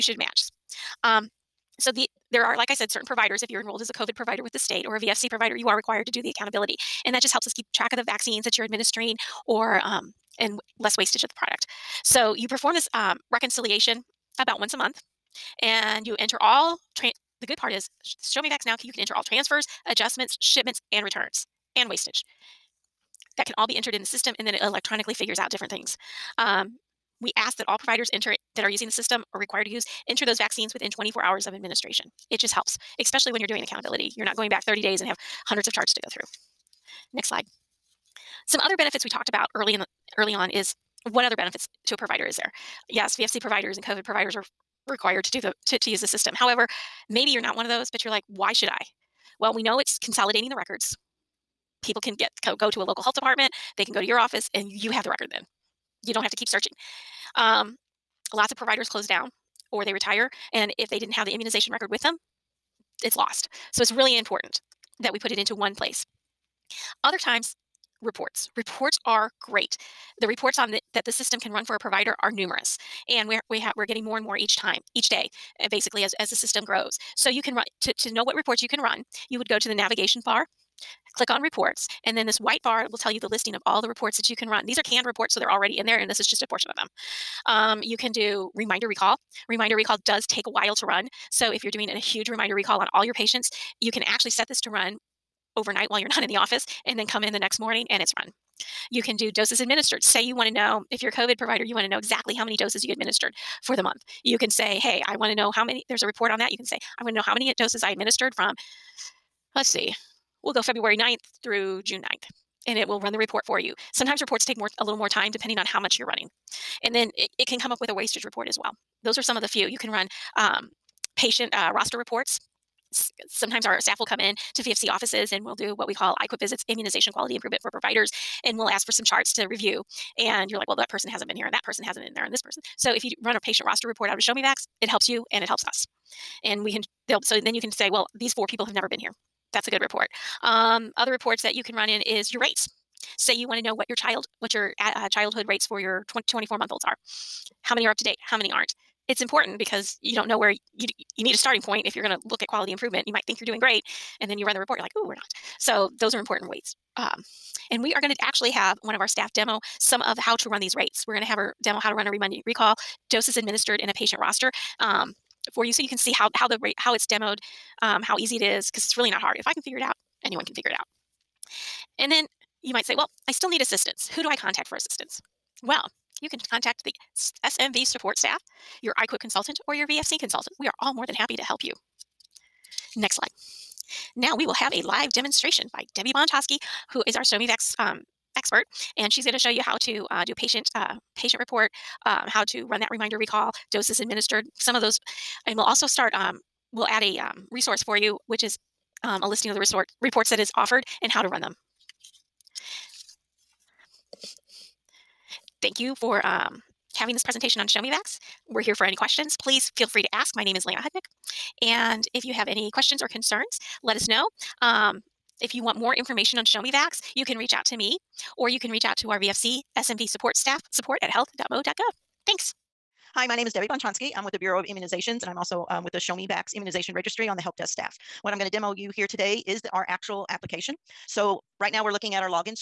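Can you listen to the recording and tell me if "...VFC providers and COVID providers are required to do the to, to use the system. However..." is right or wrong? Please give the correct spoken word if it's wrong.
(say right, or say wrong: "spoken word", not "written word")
right.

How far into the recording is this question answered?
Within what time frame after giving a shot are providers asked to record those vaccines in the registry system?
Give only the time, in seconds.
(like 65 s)
30 s.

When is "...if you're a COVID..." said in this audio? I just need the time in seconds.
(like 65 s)
100 s.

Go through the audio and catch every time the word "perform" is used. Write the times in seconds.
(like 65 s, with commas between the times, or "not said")
12 s.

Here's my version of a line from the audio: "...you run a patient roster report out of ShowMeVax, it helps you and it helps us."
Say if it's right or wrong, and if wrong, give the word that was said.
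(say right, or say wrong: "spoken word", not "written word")
right.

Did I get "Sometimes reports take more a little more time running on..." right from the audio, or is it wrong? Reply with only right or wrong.
wrong.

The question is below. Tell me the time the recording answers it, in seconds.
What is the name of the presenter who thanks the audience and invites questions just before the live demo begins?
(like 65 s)
210 s.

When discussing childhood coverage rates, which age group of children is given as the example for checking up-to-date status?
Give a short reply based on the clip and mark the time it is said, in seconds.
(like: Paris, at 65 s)
24 month olds, at 146 s.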